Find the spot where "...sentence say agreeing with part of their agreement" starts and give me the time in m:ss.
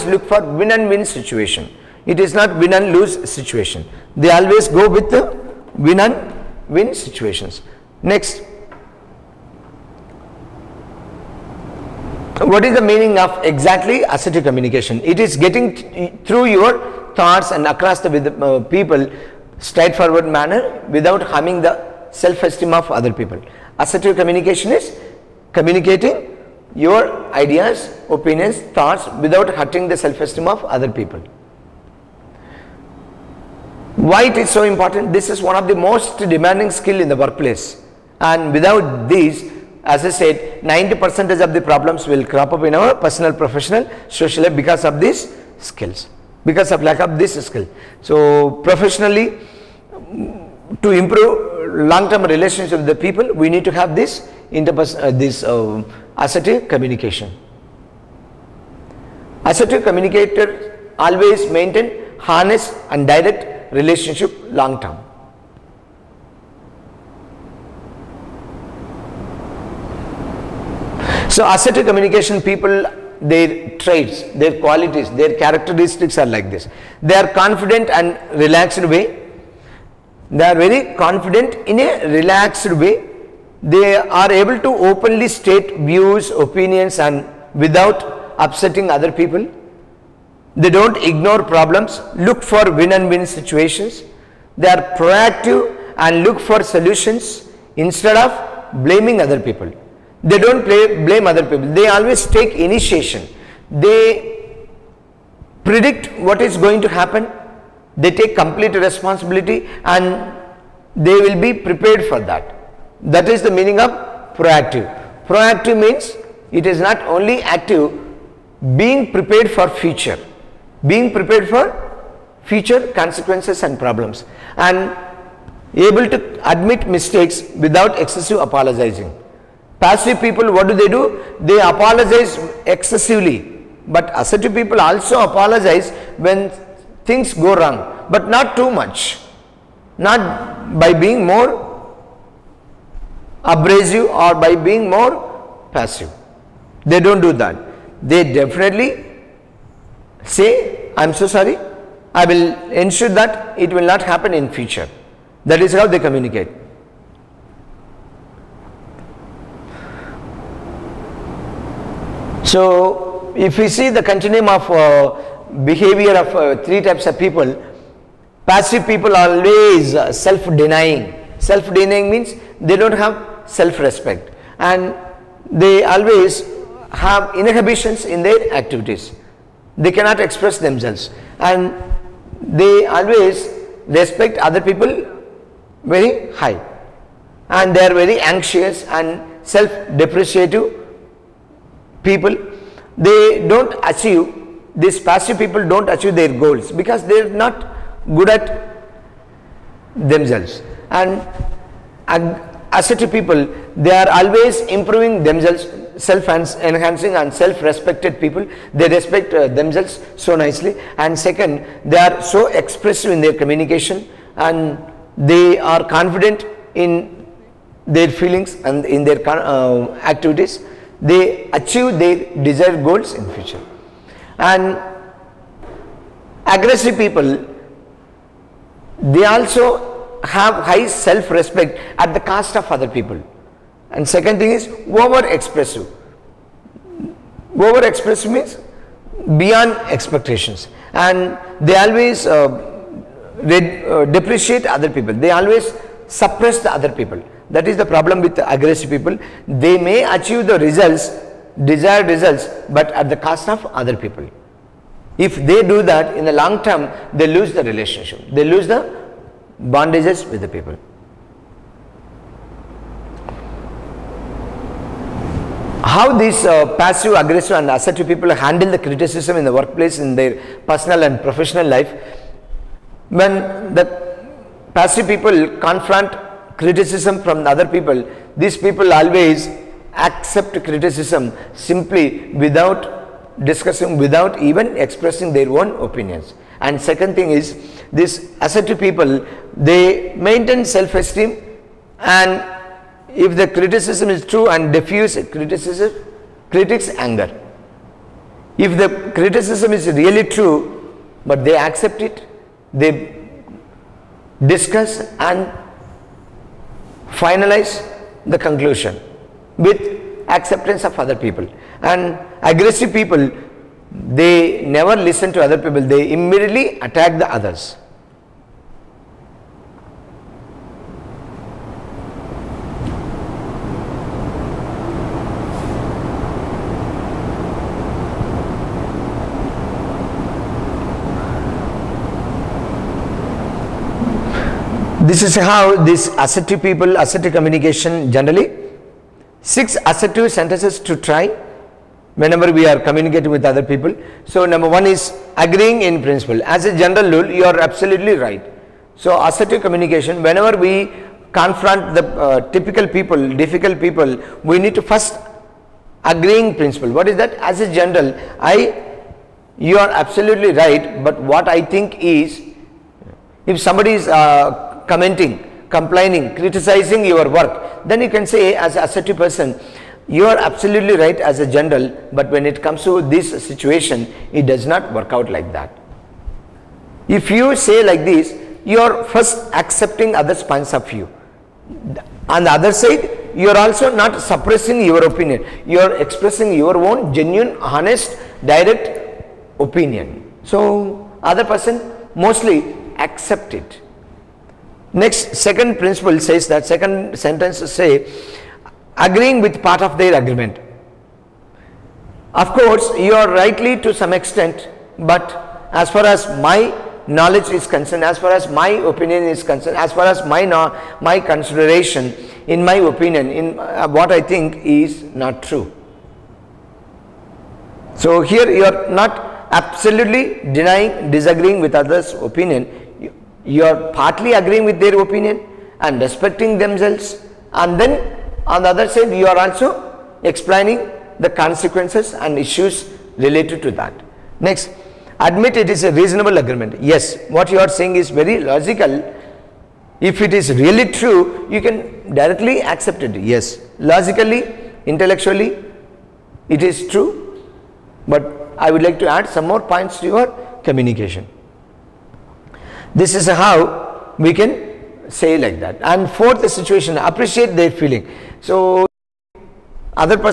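6:37.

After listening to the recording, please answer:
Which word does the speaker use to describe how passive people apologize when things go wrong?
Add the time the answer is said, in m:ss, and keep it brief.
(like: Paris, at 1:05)
excessively, at 2:11.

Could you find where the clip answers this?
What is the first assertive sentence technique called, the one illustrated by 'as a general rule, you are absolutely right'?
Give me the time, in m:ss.
5:45.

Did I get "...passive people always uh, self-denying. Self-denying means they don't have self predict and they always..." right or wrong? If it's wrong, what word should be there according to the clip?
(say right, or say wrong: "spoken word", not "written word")
wrong: "respect", not "predict".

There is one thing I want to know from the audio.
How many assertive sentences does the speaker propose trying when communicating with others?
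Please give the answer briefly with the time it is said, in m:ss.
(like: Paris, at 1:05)
6, at 5:39.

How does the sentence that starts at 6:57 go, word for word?
So here you are not absolutely denying, disagreeing with others' opinion.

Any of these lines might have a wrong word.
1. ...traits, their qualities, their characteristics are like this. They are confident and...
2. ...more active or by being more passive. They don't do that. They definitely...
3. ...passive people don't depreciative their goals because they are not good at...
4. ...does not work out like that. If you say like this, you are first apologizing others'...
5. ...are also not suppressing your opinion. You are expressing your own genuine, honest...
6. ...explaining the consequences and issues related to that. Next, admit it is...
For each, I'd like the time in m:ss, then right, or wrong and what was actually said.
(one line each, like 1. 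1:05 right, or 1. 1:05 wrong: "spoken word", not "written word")
1. 1:13 right
2. 2:21 wrong: "abrasive", not "active"
3. 3:14 wrong: "achieve", not "depreciative"
4. 6:14 wrong: "accepting", not "apologizing"
5. 6:23 right
6. 7:10 right.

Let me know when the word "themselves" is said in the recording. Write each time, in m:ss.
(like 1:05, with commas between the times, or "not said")
3:00, 3:19, 3:25, 3:29, 7:06.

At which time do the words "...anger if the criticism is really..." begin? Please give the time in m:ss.
4:57.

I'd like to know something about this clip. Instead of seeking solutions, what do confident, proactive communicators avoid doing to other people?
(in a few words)
blaming.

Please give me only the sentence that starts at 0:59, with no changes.
Assertive communicator always maintain harness and direct relationship long term.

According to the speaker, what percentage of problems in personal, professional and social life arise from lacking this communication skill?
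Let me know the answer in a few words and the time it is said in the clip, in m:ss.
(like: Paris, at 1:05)
90 percent, at 0:40.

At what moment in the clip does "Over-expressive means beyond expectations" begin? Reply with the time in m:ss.
3:57.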